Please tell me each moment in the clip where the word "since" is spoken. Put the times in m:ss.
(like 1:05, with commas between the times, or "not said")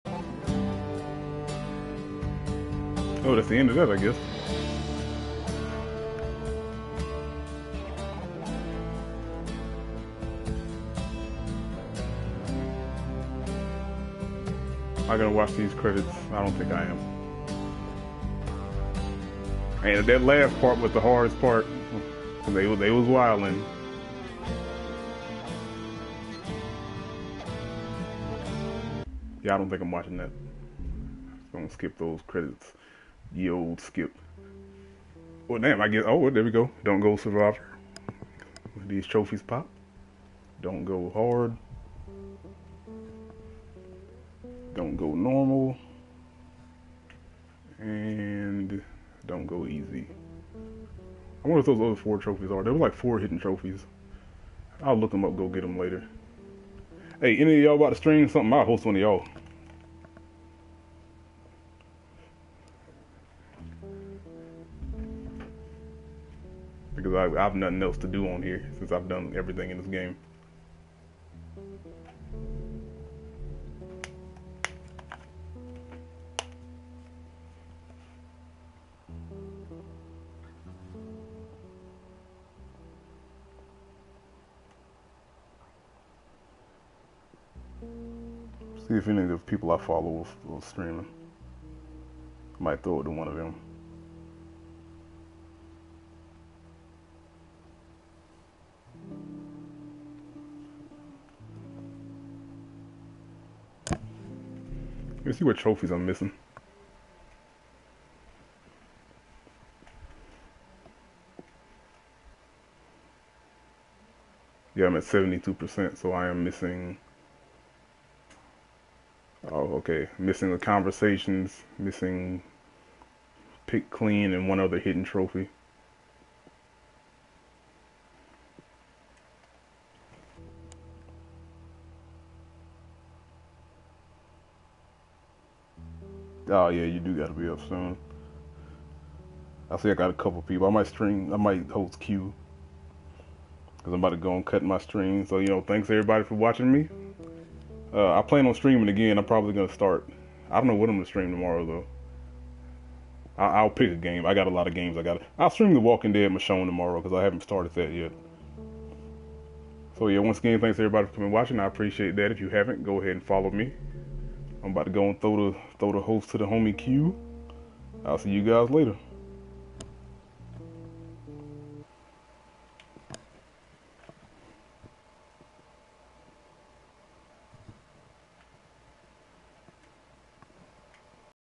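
1:08.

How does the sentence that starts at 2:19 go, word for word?
I see I got a couple people.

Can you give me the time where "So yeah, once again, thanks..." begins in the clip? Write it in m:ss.
2:39.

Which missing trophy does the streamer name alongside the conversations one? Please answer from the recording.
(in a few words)
Pick clean.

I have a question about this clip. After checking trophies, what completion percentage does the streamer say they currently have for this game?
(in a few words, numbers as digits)
72%.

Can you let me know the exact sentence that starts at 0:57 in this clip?
Hey, any of y'all about to stream something?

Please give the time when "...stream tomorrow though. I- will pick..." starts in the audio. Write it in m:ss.
2:31.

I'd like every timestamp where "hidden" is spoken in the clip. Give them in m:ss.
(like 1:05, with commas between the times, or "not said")
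0:53, 2:04.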